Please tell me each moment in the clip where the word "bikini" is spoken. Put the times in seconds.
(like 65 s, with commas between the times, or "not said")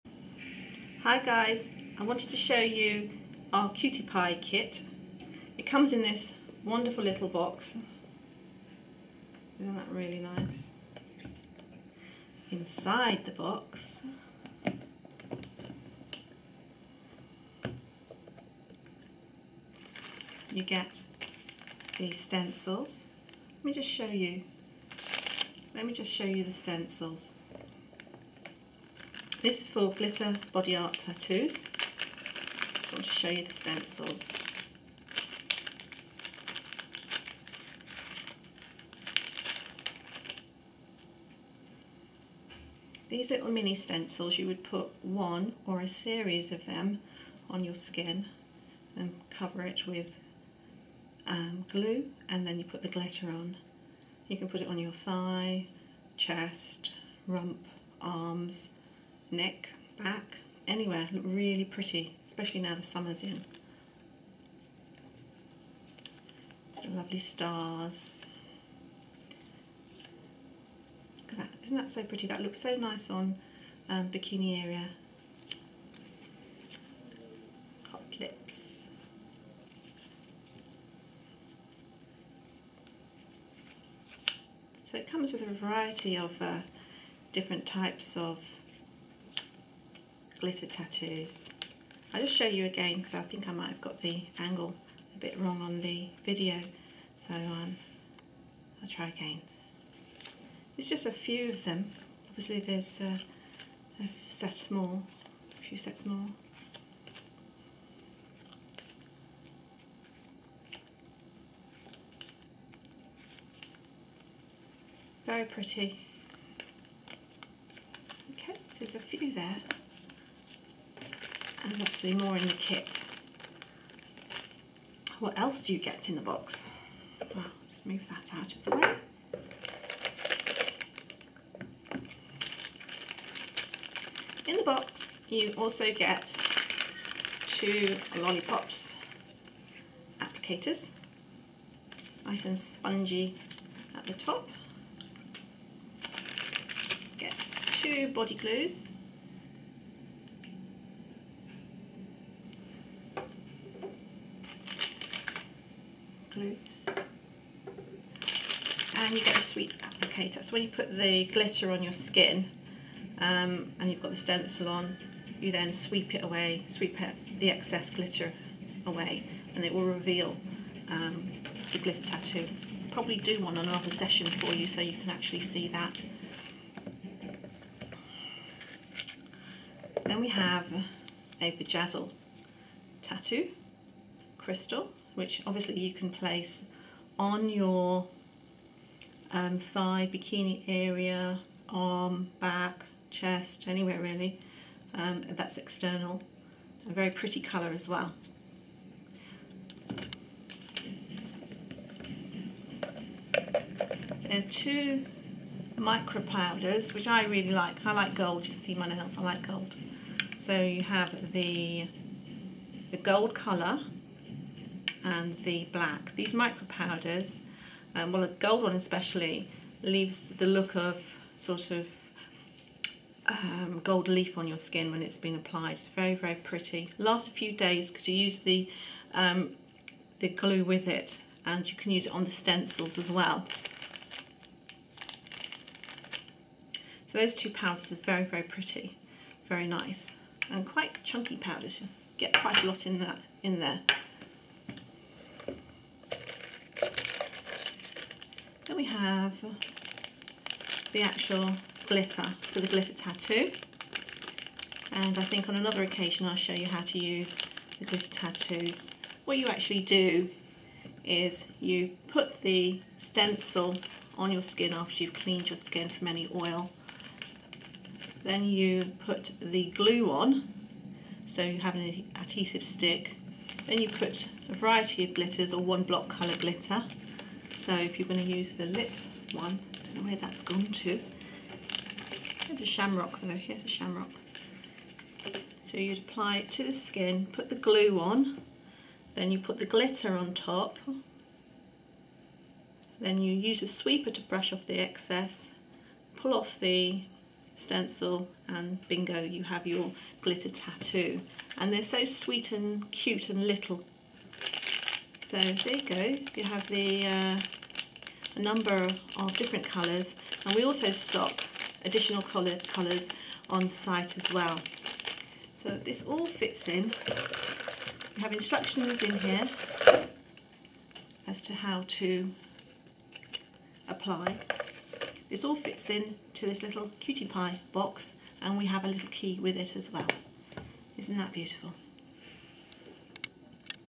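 74 s, 190 s.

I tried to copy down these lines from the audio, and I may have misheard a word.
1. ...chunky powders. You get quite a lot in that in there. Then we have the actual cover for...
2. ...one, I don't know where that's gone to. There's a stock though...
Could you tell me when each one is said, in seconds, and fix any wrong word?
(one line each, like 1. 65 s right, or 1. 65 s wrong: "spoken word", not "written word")
1. 241 s wrong: "glitter", not "cover"
2. 279 s wrong: "shamrock", not "stock".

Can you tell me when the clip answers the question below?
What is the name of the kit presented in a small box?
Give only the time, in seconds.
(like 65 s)
3 s.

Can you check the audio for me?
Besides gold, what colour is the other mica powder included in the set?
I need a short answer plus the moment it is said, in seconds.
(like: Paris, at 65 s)
black, at 215 s.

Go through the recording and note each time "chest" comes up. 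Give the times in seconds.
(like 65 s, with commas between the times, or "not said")
56 s, 193 s.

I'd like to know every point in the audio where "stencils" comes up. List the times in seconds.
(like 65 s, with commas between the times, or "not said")
22 s, 26 s, 33 s, 43 s, 164 s, 232 s, 262 s, 297 s.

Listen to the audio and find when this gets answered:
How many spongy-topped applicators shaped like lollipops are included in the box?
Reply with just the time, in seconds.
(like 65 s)
137 s.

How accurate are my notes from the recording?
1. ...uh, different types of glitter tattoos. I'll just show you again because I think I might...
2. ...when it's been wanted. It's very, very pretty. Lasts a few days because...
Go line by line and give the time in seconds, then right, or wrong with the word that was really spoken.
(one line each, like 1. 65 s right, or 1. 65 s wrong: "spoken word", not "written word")
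1. 86 s right
2. 224 s wrong: "applied", not "wanted".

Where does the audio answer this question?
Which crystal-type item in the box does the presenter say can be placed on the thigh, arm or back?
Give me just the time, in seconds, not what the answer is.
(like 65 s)
181 s.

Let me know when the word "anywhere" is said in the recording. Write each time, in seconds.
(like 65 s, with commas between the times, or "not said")
60 s, 193 s.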